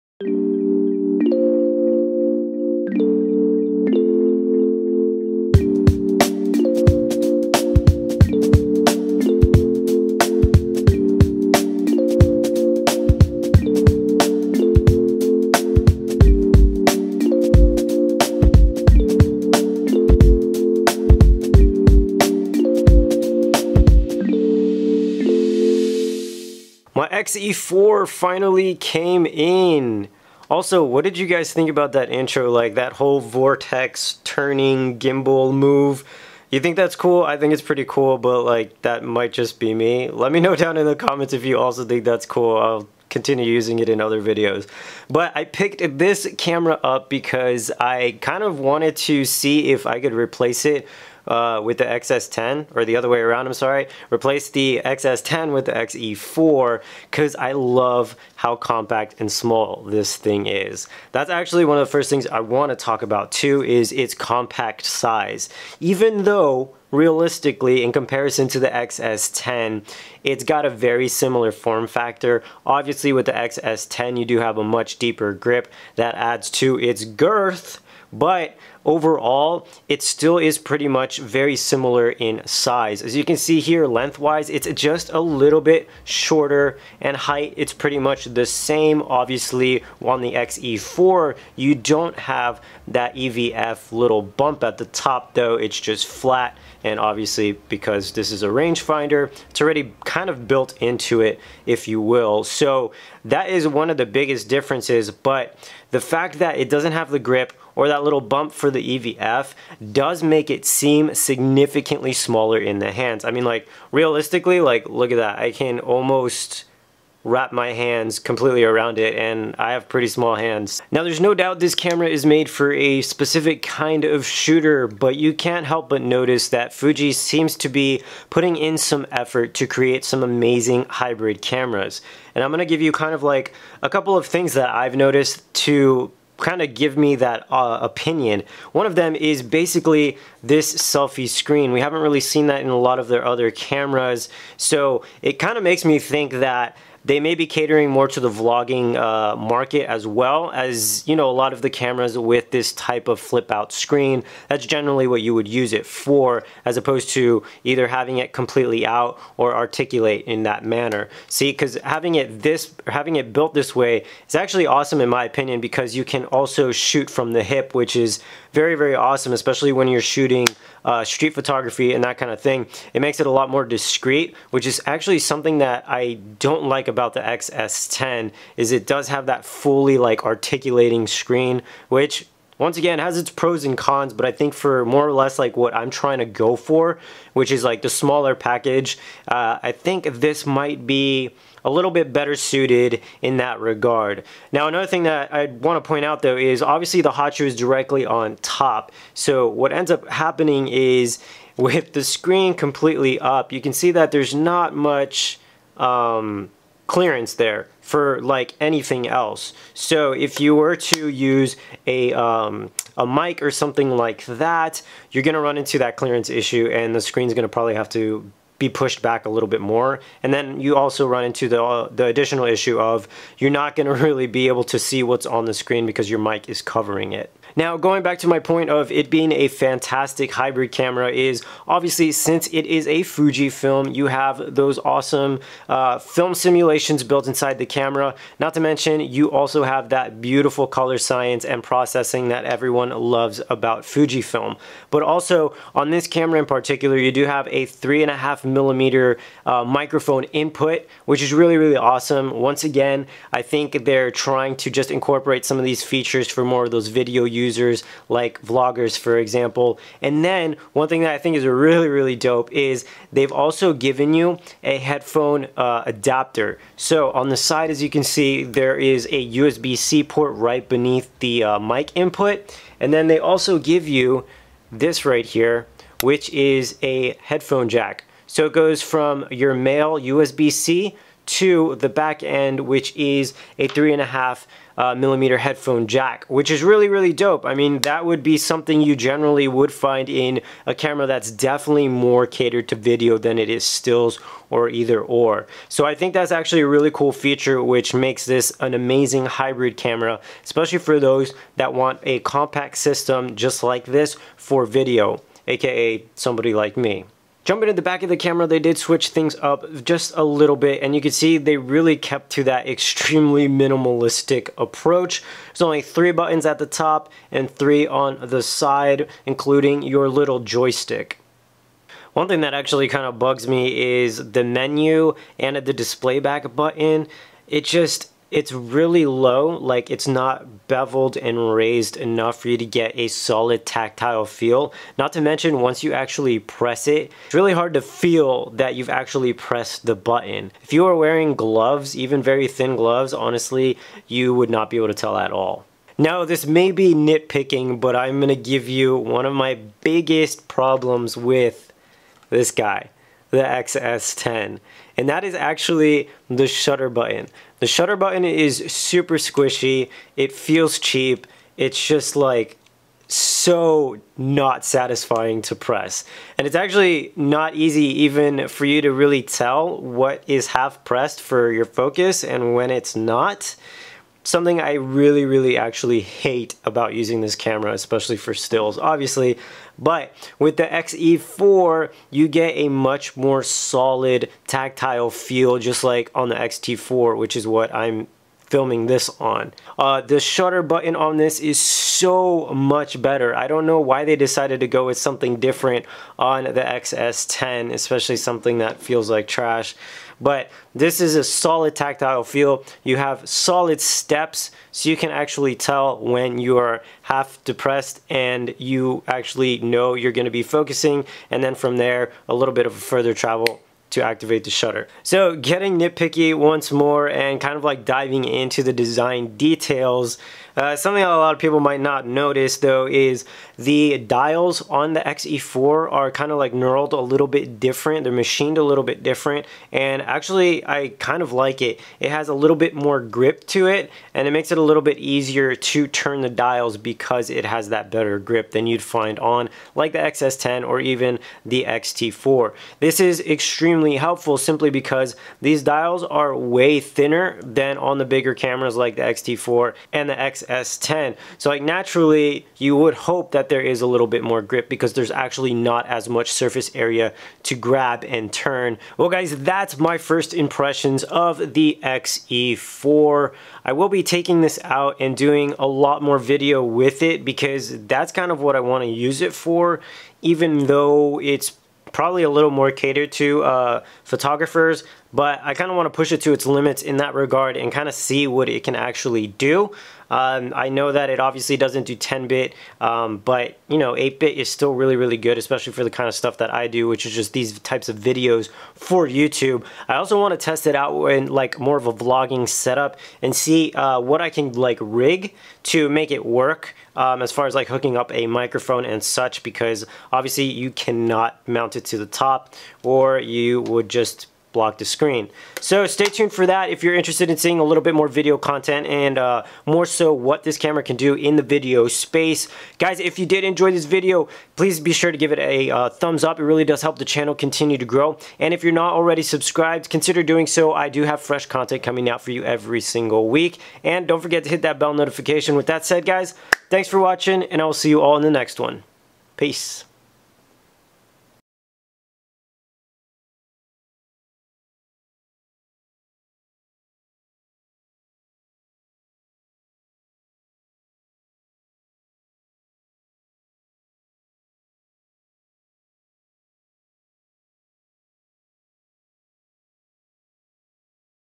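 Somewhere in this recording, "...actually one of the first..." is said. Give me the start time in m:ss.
1:01.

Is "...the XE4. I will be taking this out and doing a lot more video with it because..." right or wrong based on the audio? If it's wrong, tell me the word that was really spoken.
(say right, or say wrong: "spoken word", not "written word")
right.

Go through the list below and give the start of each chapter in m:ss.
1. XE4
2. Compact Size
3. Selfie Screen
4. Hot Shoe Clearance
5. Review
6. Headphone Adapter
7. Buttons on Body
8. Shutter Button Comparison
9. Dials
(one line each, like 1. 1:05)
1. 0:26
2. 1:01
3. 2:19
4. 3:15
5. 3:47
6. 4:20
7. 5:08
8. 5:46
9. 7:00.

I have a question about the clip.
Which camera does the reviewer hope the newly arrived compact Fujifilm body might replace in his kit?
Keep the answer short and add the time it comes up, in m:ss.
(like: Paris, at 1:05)
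XS10, at 0:54.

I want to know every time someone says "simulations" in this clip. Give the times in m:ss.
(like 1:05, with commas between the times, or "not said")
3:56.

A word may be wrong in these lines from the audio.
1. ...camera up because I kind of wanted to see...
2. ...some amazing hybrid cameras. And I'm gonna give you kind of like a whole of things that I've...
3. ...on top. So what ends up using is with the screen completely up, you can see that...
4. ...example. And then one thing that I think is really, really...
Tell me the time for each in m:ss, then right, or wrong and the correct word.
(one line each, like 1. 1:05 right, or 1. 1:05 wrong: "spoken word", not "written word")
1. 0:46 right
2. 2:10 wrong: "couple", not "whole"
3. 3:18 wrong: "happening", not "using"
4. 4:19 right.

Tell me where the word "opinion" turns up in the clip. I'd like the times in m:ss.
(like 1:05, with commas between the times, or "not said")
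2:17, 2:45.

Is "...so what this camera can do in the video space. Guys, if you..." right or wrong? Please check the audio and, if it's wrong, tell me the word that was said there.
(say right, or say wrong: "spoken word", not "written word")
right.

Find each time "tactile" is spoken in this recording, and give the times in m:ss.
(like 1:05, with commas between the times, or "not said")
5:33, 6:24, 6:41.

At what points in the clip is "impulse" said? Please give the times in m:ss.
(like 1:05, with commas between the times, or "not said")
not said.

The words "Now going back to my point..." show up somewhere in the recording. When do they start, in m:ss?
3:47.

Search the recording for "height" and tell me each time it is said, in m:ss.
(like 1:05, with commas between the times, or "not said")
1:27.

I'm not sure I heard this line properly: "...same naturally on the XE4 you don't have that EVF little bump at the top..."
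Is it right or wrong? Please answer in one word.
wrong.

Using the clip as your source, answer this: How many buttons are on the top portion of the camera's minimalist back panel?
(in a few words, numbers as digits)
3.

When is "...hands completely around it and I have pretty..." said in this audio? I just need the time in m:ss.
1:57.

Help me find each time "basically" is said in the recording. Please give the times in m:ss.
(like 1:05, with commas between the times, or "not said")
2:19.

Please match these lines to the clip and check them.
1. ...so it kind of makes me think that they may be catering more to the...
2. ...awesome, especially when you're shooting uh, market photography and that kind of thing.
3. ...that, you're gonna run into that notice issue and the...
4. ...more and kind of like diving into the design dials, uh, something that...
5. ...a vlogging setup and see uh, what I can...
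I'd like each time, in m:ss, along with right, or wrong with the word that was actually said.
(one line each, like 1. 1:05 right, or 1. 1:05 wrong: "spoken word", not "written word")
1. 2:24 right
2. 2:48 wrong: "street", not "market"
3. 3:34 wrong: "clearance", not "notice"
4. 6:56 wrong: "details", not "dials"
5. 8:11 right.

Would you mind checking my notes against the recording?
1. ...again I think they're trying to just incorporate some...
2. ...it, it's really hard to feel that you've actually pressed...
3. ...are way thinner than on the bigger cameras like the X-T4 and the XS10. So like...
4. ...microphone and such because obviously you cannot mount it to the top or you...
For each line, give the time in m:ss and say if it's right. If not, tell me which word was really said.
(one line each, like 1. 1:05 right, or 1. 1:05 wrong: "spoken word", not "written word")
1. 4:12 right
2. 5:36 right
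3. 7:26 right
4. 8:18 right.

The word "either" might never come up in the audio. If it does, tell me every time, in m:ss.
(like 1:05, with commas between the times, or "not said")
2:37, 4:54.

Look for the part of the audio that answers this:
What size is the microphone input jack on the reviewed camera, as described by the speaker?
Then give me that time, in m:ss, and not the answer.
4:07.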